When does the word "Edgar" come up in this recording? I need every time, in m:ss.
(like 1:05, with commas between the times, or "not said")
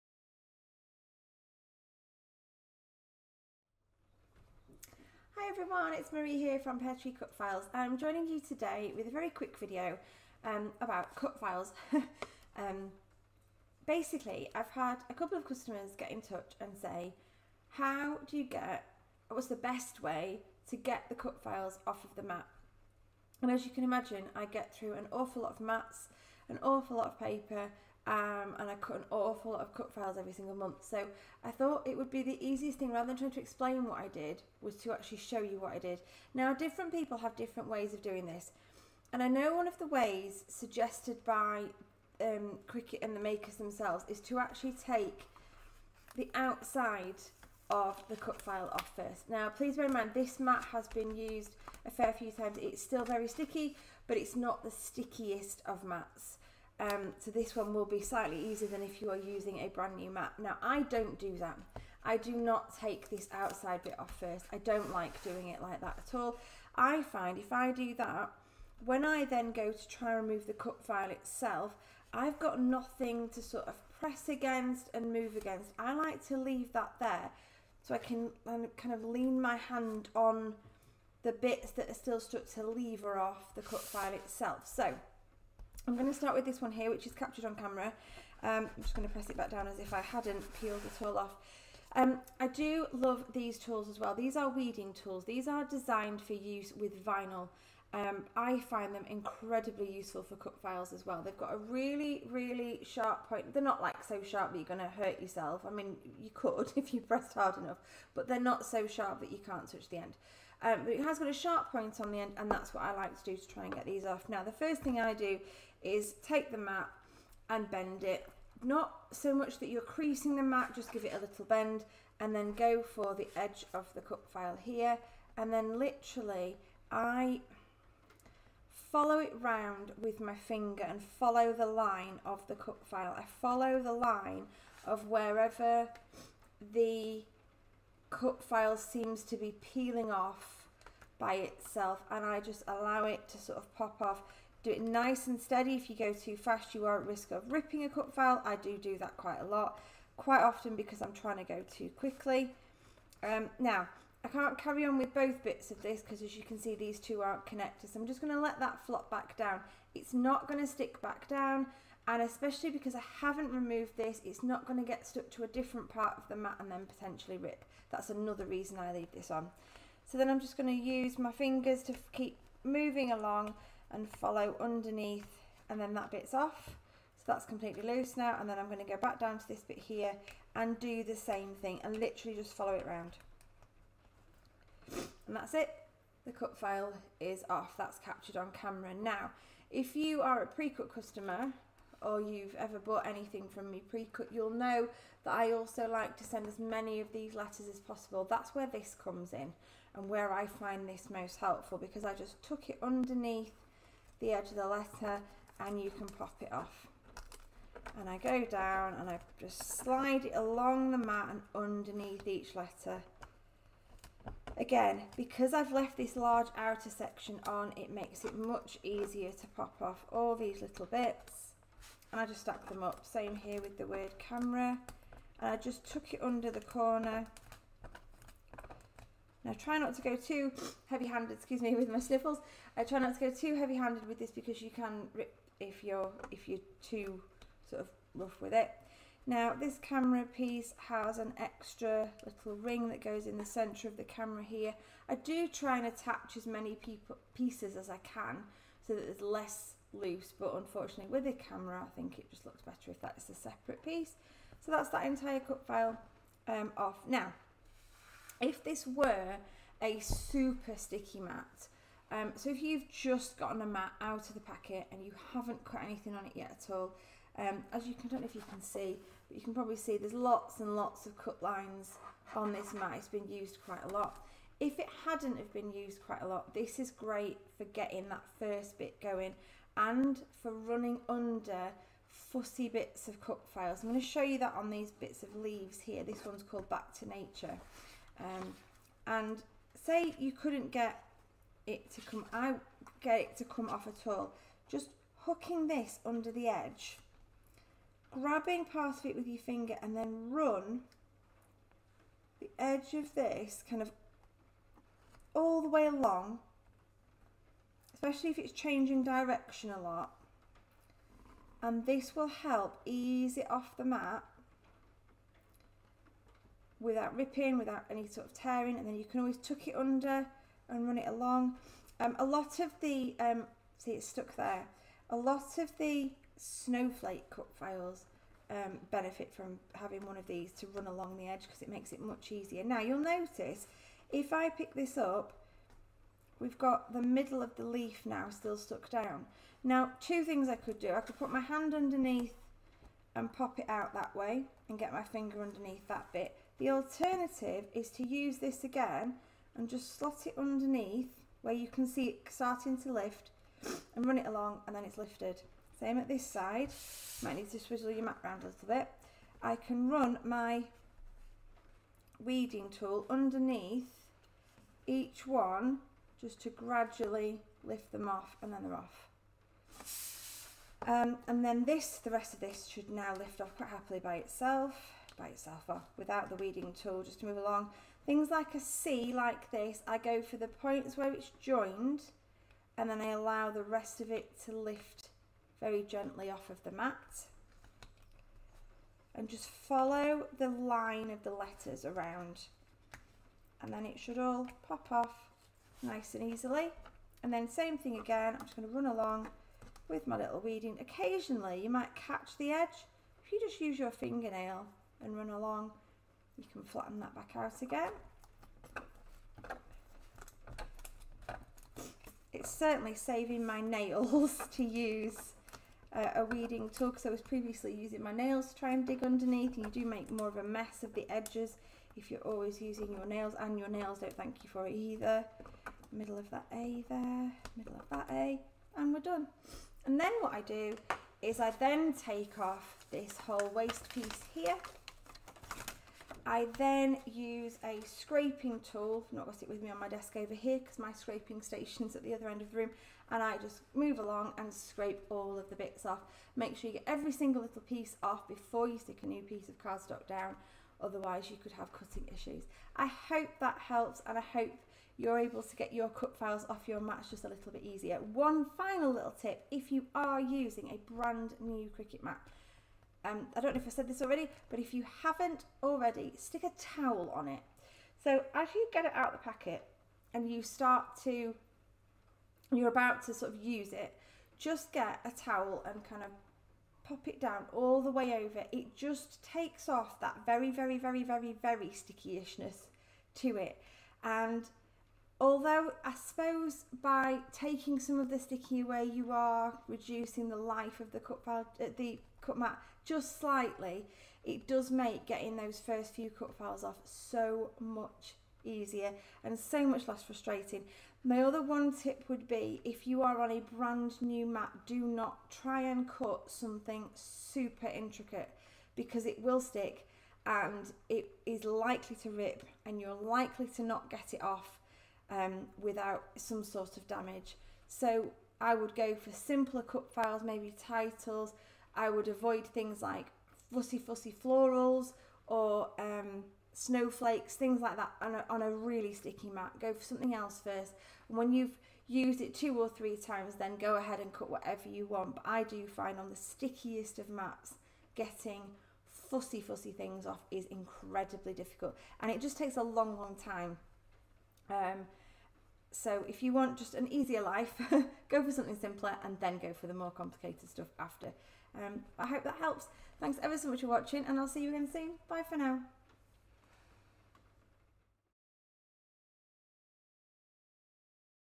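not said.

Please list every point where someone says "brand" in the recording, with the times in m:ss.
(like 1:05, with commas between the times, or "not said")
0:59, 7:40, 8:23.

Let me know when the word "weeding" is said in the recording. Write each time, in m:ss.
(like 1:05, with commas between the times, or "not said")
1:34, 6:02, 6:16, 6:40, 6:56.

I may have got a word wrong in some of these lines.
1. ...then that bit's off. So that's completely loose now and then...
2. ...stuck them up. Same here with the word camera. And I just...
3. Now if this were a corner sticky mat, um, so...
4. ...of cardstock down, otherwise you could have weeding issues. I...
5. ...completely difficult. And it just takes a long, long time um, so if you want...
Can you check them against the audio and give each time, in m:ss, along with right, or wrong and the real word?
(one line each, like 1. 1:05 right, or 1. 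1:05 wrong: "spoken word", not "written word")
1. 2:55 right
2. 3:42 wrong: "stack", not "stuck"
3. 4:17 wrong: "super", not "corner"
4. 7:29 wrong: "cutting", not "weeding"
5. 9:00 wrong: "incredibly", not "completely".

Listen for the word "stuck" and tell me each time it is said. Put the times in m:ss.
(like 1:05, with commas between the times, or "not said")
1:22, 2:45, 5:24, 5:38.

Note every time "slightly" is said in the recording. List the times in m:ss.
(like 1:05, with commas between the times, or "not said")
0:58, 8:13.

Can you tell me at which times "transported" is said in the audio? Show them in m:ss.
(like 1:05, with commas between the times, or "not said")
not said.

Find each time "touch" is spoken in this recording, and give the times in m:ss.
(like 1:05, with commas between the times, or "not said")
0:16, 1:49.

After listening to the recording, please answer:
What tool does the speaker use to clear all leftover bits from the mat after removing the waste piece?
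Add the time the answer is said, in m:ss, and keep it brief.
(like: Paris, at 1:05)
Scraping tool, at 7:17.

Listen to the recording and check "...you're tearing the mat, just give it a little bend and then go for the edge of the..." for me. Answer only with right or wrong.
wrong.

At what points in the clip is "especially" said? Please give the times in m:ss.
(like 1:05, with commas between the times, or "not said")
2:42, 5:07.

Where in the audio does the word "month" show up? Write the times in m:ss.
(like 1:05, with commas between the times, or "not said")
0:30.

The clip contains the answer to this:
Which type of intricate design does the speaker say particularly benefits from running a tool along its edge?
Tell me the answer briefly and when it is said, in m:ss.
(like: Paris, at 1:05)
Snowflakes, at 5:26.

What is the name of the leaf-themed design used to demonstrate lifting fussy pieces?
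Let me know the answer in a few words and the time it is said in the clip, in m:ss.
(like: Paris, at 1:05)
Back to Nature, at 4:46.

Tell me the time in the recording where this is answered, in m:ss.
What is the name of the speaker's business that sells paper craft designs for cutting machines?
0:06.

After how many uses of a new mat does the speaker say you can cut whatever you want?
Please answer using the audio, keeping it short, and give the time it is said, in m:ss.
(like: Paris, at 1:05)
2 or 3, at 8:52.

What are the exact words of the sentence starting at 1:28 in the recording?
Um, I'm just going to press it back down as if I hadn't peeled it all off.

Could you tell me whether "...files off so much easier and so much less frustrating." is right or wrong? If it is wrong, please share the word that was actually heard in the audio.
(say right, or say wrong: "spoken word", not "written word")
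right.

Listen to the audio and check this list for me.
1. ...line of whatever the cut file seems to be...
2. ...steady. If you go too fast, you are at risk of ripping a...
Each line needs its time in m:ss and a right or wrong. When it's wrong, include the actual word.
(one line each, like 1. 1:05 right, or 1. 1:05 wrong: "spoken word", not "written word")
1. 2:13 wrong: "wherever", not "whatever"
2. 2:25 right.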